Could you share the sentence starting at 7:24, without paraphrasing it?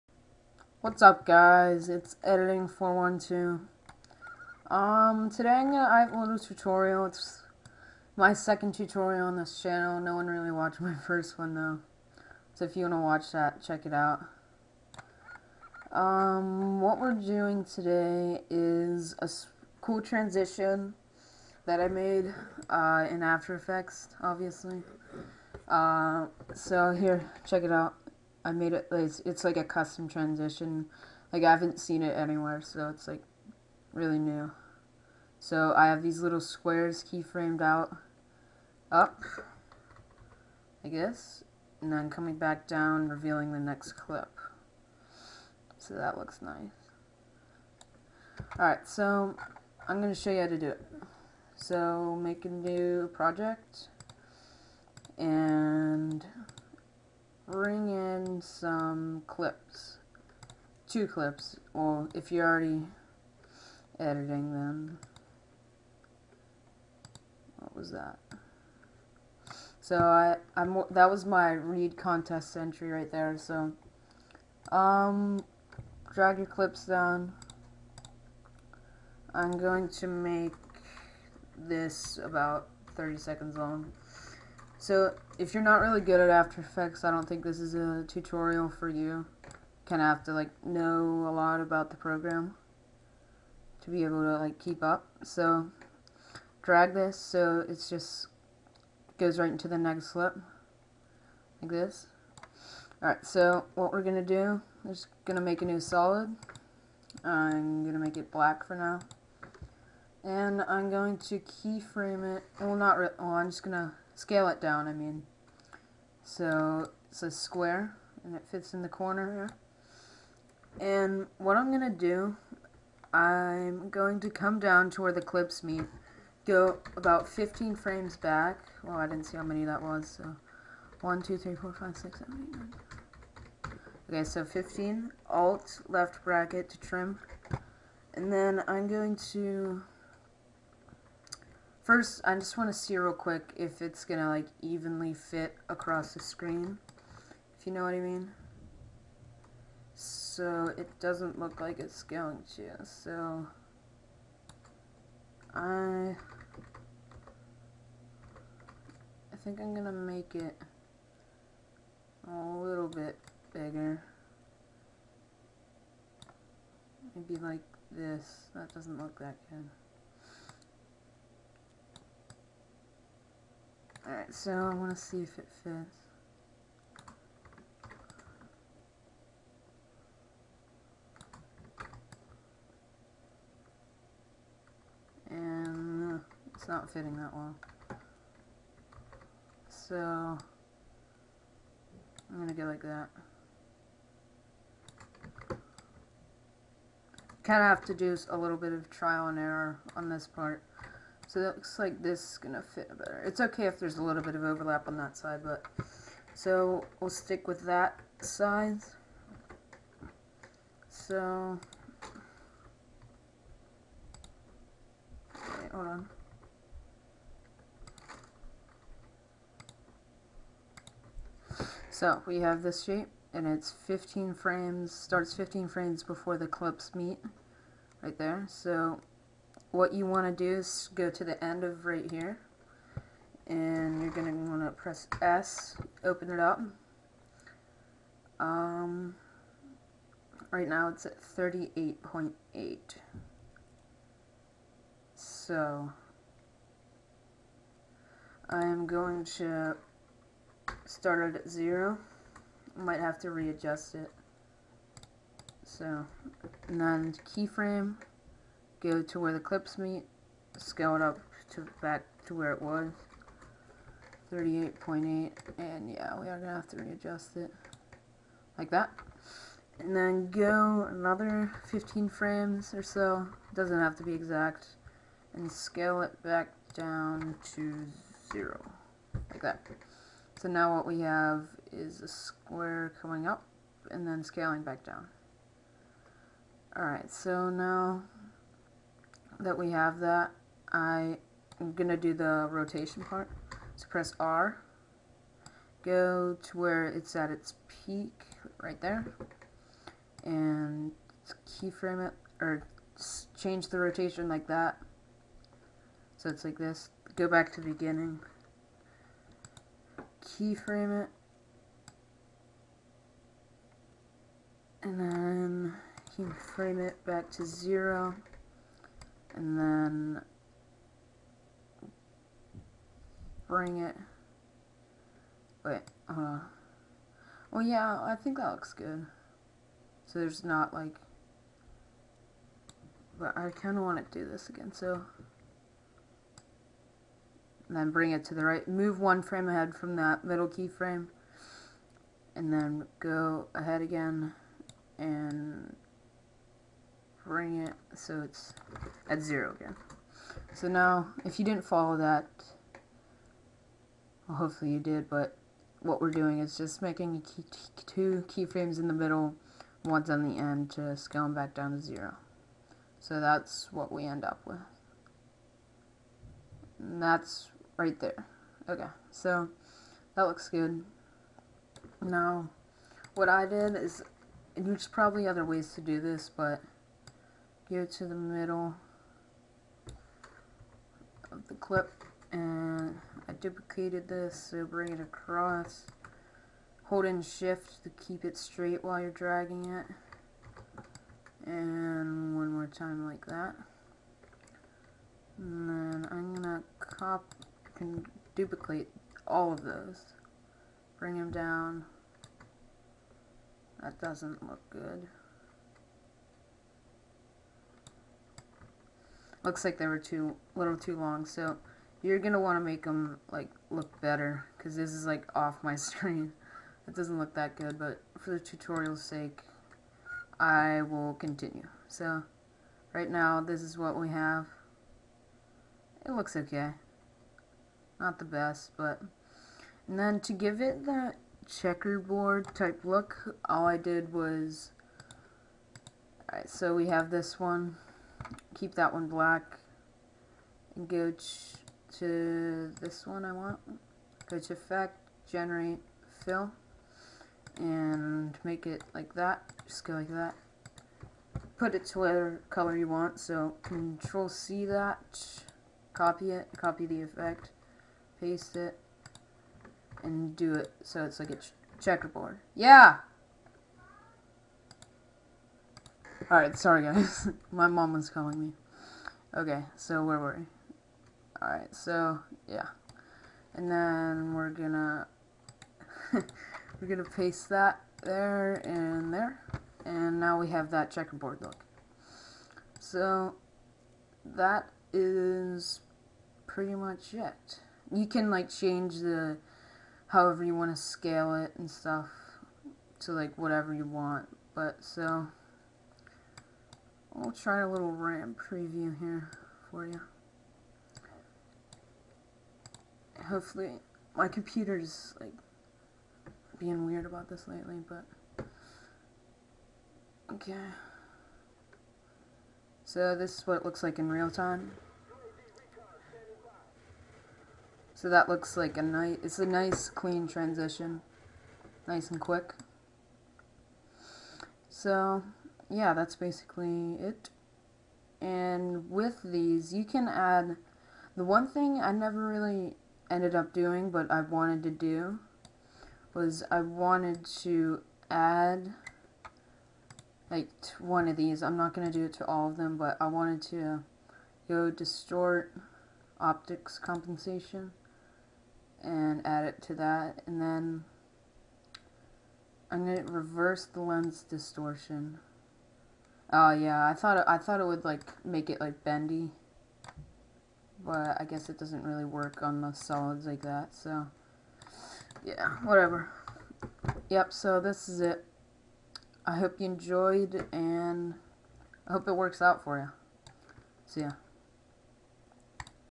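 Go to effect, generate, fill, and make it like that.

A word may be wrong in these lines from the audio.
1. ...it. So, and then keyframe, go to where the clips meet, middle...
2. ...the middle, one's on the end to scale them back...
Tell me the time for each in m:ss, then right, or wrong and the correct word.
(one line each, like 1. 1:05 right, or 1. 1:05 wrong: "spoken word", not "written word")
1. 4:13 wrong: "scale", not "middle"
2. 5:58 right.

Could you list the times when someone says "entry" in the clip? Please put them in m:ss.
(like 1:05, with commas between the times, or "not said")
1:12.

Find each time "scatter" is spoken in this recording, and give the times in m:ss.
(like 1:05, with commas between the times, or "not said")
not said.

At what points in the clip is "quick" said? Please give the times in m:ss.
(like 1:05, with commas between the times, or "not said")
2:23, 8:42.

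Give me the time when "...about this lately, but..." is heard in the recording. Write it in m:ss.
8:27.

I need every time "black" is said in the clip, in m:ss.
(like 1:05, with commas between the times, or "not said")
1:48, 7:19.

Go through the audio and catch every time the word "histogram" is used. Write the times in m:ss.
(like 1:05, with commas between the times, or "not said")
not said.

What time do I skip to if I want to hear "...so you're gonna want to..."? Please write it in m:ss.
6:51.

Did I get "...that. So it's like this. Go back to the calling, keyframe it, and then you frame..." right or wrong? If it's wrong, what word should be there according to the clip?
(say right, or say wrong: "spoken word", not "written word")
wrong: "beginning", not "calling".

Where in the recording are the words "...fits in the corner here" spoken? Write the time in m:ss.
1:58.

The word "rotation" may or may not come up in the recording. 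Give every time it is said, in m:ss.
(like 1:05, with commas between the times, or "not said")
4:52, 5:03.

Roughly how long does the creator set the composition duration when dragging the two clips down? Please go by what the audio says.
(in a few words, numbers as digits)
30 seconds.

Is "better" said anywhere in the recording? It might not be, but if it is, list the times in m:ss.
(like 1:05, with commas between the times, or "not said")
3:22, 6:54.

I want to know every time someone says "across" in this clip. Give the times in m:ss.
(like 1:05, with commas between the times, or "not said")
2:25, 6:24.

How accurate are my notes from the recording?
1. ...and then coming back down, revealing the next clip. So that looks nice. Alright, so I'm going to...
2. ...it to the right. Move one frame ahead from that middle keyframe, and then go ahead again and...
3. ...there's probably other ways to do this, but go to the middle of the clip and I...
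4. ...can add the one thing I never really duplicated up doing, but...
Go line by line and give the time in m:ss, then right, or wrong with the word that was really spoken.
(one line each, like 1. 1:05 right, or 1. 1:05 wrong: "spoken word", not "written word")
1. 0:41 right
2. 5:38 right
3. 6:14 right
4. 8:49 wrong: "ended", not "duplicated".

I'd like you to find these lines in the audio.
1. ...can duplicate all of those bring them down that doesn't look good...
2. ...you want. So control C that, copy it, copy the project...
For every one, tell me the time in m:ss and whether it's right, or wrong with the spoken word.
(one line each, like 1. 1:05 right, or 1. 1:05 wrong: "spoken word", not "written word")
1. 6:37 right
2. 7:32 wrong: "effect", not "project".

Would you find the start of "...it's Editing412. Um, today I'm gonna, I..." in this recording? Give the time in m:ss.
0:01.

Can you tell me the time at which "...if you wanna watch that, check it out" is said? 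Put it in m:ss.
0:12.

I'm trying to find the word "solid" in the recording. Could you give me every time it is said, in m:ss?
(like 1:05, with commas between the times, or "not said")
1:45, 9:22.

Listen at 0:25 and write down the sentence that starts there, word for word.
Uh, so here, check it out.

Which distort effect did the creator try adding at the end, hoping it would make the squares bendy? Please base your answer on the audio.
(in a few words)
Optics Compensation.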